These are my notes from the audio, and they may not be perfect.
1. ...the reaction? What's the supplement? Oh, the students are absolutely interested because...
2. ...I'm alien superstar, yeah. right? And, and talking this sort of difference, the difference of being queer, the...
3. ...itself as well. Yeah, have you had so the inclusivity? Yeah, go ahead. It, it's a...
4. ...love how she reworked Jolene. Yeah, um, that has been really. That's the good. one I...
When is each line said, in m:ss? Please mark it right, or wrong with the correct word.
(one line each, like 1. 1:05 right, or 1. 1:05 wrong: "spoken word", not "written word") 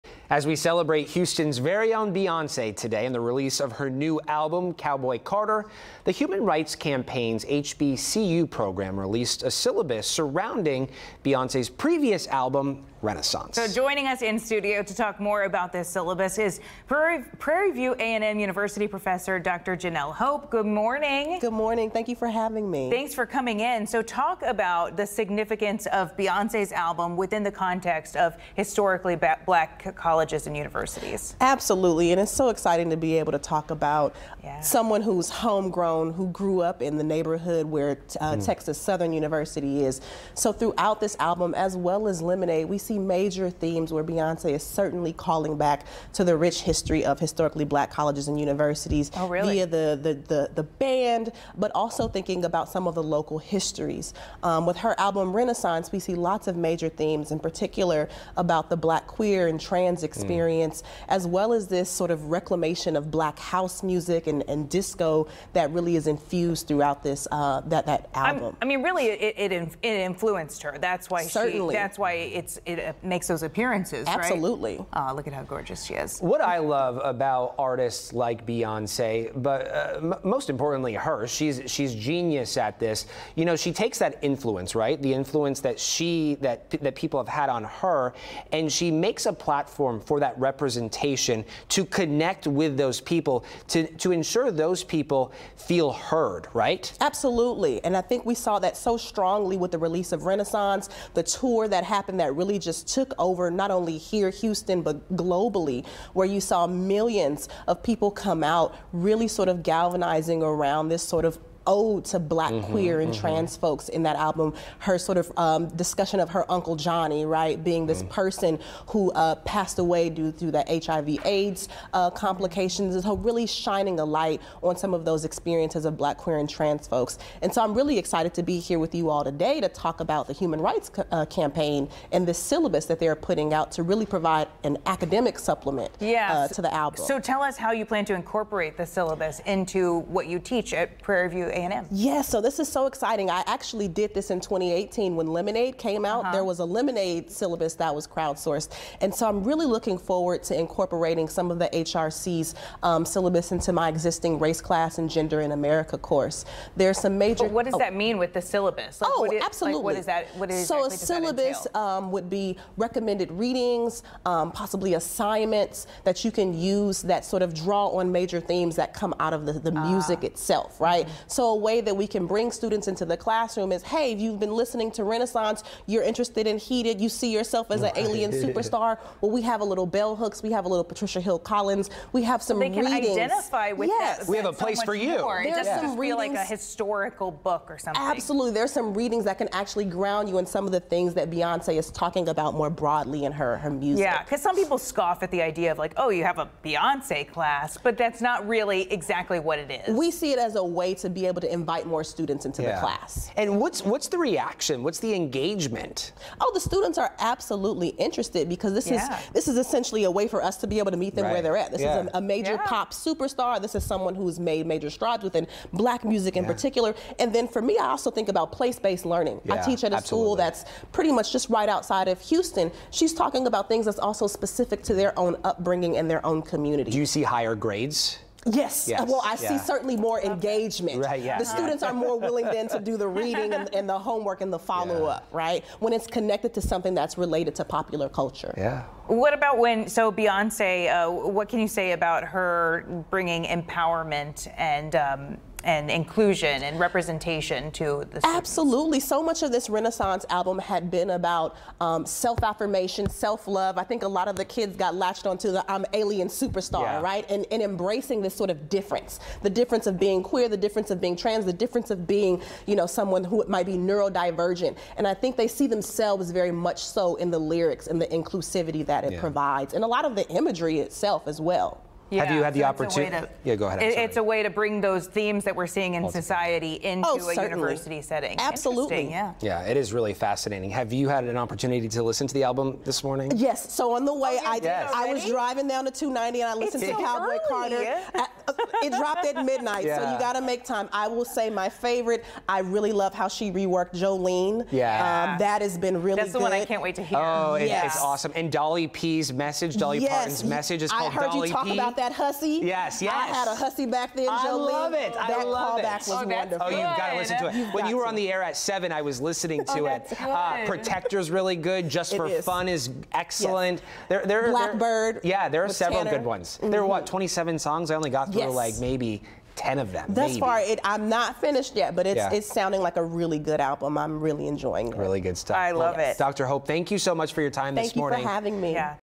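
1. 3:24 wrong: "engagement", not "supplement"
2. 4:15 wrong: "embracing", not "talking"
3. 4:30 wrong: "opportunity", not "inclusivity"
4. 4:52 right.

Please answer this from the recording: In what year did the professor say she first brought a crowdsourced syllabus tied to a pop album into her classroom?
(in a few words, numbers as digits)
2018.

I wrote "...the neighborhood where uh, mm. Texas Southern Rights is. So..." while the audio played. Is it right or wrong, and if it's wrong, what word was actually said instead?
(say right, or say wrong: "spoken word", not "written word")
wrong: "University", not "Rights".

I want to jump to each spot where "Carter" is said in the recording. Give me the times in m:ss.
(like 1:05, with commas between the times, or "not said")
0:05, 4:47.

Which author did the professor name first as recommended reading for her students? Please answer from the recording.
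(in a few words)
bell hooks.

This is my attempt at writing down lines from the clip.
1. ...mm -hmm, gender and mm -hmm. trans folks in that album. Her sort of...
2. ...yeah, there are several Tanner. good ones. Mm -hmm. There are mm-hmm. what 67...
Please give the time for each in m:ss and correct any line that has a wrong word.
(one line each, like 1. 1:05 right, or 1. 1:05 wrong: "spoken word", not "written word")
1. 1:52 wrong: "queer", not "gender"
2. 5:15 wrong: "27", not "67".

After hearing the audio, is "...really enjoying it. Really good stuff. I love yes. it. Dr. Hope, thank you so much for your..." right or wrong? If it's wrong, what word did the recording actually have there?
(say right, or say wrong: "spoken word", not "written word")
right.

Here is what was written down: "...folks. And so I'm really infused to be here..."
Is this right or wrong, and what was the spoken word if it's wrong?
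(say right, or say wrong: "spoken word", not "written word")
wrong: "excited", not "infused".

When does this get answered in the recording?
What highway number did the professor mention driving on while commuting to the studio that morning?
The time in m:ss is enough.
4:45.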